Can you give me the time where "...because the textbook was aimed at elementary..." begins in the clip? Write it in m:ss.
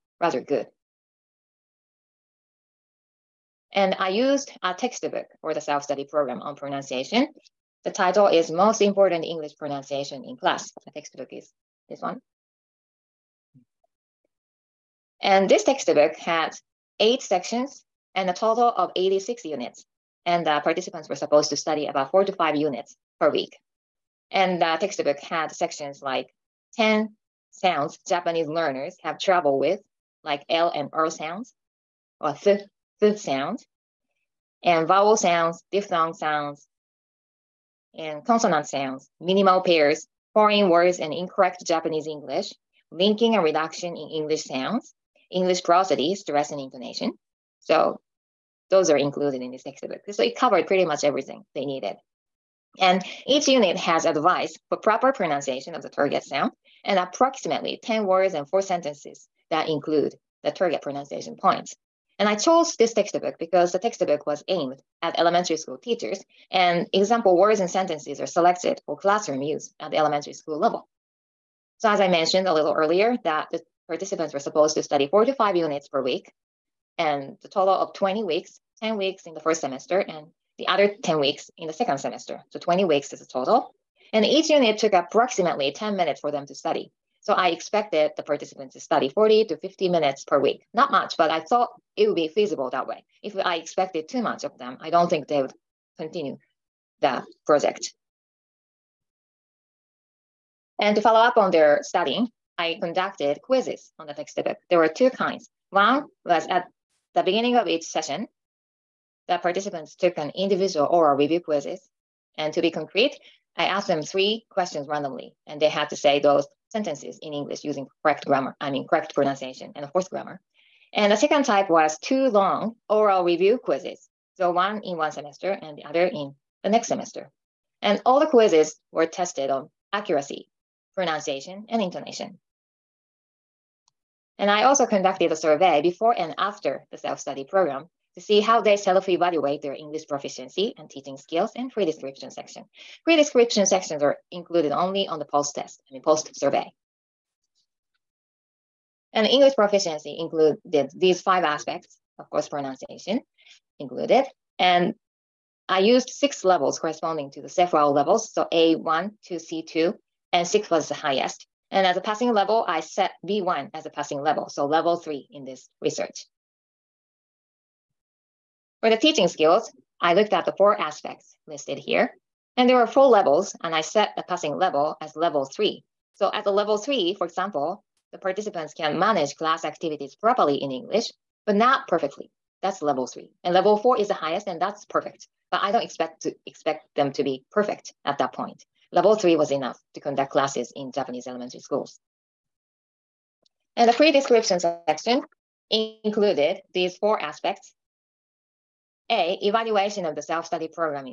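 1:03.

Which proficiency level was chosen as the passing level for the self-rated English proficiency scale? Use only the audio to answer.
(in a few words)
B1.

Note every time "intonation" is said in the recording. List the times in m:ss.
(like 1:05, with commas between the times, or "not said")
0:46, 2:11.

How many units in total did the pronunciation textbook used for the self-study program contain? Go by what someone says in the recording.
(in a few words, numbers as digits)
86.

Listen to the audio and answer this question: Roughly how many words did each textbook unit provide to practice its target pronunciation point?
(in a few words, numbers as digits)
10.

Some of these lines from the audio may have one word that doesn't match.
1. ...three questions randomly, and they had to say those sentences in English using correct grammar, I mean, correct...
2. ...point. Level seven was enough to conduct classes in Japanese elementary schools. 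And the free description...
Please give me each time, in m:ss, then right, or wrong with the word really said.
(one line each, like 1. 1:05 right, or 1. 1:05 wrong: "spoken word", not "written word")
1. 1:54 right
2. 3:08 wrong: "three", not "seven".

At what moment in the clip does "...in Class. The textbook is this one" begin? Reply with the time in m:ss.
0:10.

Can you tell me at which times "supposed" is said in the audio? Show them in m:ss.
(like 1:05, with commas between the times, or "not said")
0:21, 1:14.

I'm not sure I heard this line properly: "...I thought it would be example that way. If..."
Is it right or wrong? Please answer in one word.
wrong.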